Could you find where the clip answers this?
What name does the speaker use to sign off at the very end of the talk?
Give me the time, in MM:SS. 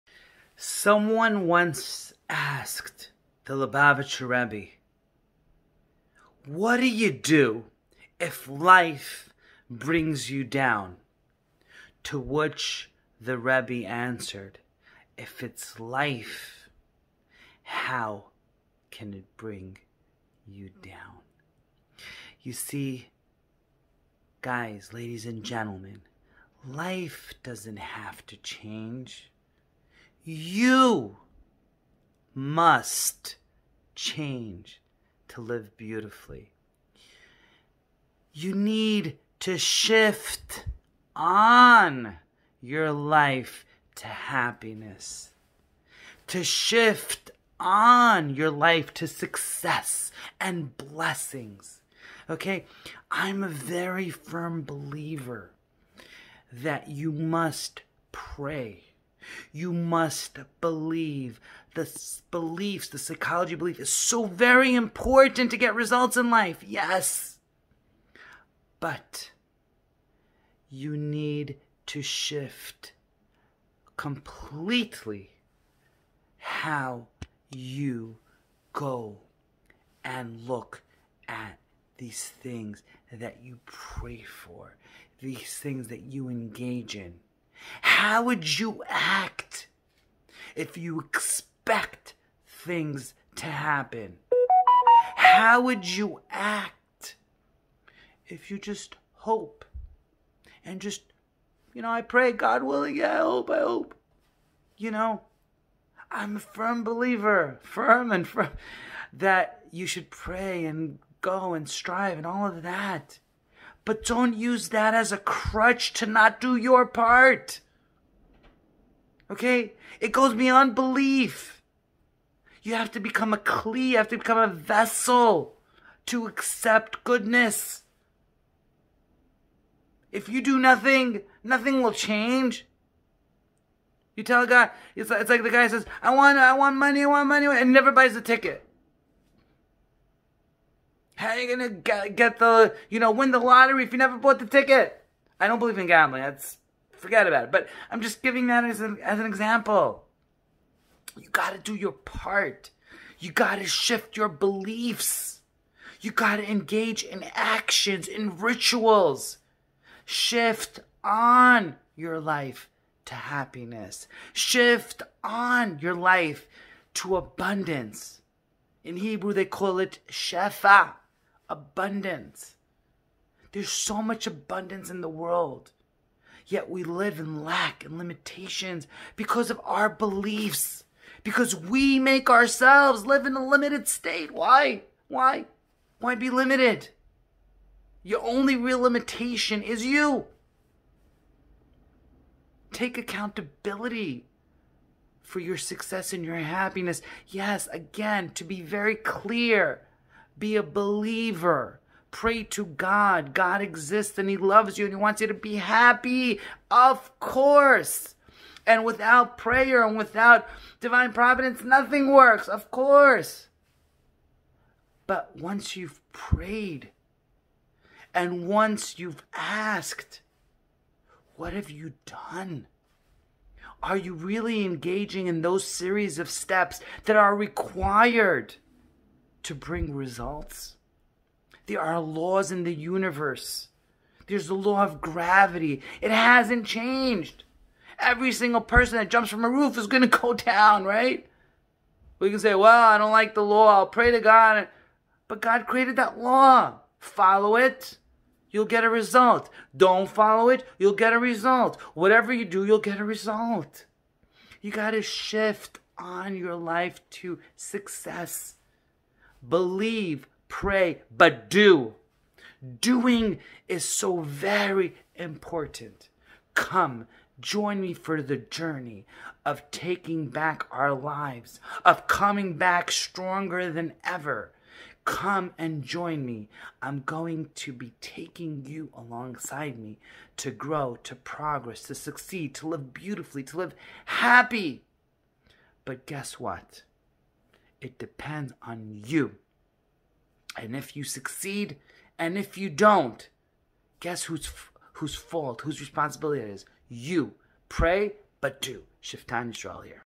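04:59.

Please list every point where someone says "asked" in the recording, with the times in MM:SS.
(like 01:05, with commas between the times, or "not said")
00:02, 03:39.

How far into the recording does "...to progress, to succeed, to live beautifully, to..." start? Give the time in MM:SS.
04:41.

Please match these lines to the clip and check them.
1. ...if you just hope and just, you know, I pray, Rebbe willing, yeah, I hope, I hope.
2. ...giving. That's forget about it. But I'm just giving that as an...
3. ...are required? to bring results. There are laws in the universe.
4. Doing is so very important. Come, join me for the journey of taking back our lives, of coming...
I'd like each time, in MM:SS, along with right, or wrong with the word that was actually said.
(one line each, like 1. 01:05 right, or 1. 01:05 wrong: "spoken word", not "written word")
1. 01:38 wrong: "God", not "Rebbe"
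2. 02:25 wrong: "gambling", not "giving"
3. 03:47 right
4. 04:22 right.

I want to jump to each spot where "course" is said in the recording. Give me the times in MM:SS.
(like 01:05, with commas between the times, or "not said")
03:27, 03:32.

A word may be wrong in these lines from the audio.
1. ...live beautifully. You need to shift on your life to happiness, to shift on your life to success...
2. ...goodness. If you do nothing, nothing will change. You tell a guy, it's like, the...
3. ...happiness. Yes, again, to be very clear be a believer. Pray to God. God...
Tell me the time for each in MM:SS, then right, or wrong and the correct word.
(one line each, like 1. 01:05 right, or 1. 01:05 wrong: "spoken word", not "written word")
1. 00:35 right
2. 02:07 right
3. 03:16 right.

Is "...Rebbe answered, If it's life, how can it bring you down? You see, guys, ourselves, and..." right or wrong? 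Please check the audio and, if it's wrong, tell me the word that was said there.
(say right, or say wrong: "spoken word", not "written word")
wrong: "ladies", not "ourselves".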